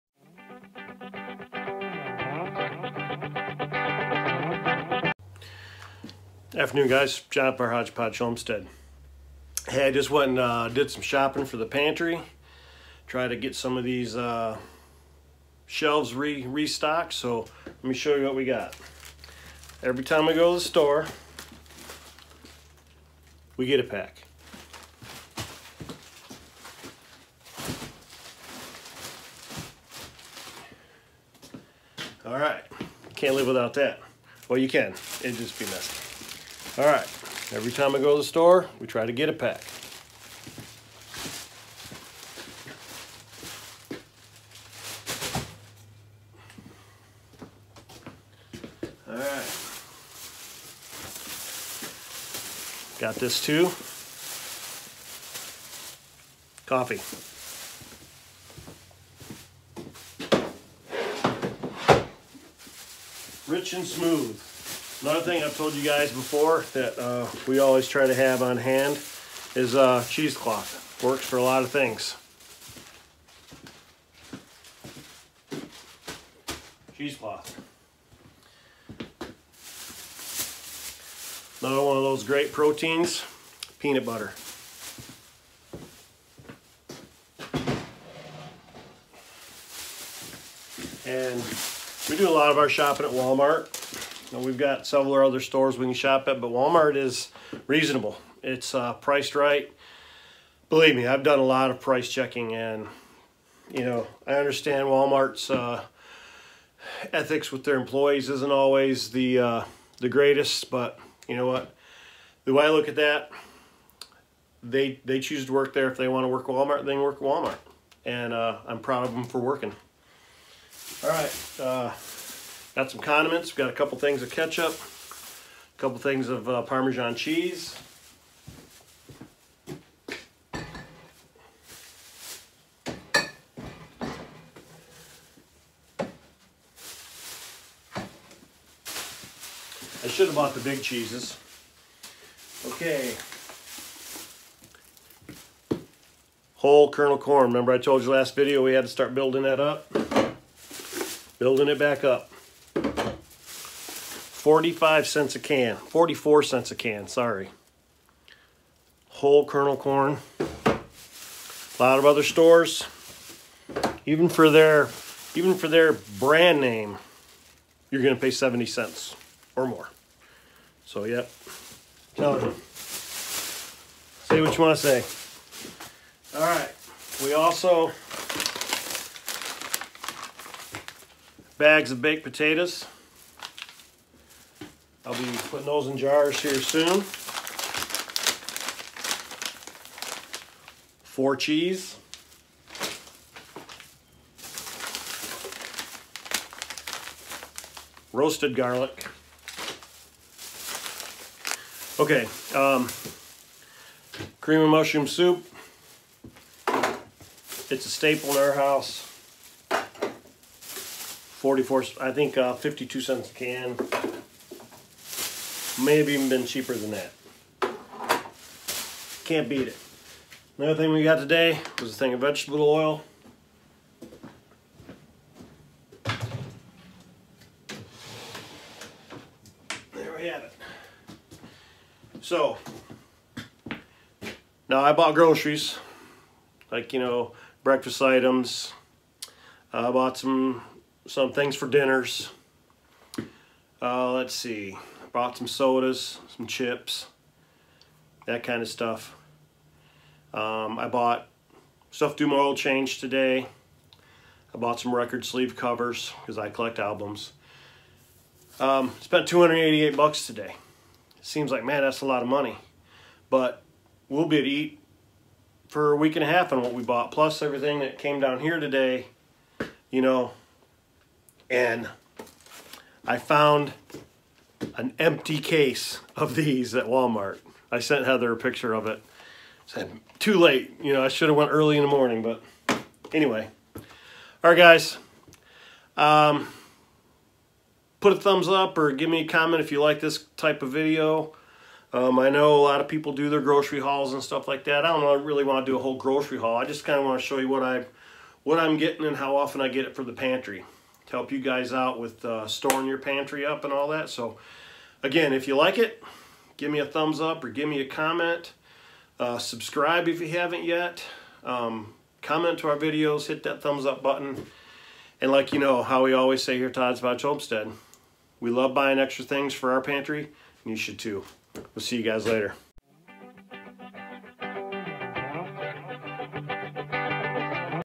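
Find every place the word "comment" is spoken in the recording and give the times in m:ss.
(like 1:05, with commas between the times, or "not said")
4:49, 5:07, 5:12.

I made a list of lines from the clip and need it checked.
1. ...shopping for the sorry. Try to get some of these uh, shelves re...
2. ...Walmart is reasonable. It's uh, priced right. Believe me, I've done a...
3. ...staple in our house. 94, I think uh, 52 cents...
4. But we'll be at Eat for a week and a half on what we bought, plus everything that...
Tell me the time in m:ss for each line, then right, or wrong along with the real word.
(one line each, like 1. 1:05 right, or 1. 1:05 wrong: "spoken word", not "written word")
1. 0:11 wrong: "pantry", not "sorry"
2. 1:36 right
3. 3:27 wrong: "44", not "94"
4. 4:23 right.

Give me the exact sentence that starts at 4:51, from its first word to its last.
Um, I know a lot of people do their grocery hauls and stuff like that.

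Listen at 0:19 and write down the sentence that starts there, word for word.
Every time we go to the store, we get a pack.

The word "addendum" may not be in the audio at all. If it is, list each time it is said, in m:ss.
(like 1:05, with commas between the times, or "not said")
not said.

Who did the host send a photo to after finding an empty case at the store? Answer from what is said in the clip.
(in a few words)
Heather.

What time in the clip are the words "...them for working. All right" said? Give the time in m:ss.
1:59.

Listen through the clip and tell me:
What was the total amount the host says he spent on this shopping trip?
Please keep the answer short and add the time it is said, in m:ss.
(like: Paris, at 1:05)
$288, at 4:19.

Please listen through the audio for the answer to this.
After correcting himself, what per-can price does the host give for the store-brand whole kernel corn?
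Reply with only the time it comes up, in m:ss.
2:35.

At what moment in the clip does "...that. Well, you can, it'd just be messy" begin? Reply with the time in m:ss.
0:33.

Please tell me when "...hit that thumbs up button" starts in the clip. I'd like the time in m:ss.
5:13.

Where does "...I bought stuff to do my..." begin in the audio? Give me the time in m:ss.
4:10.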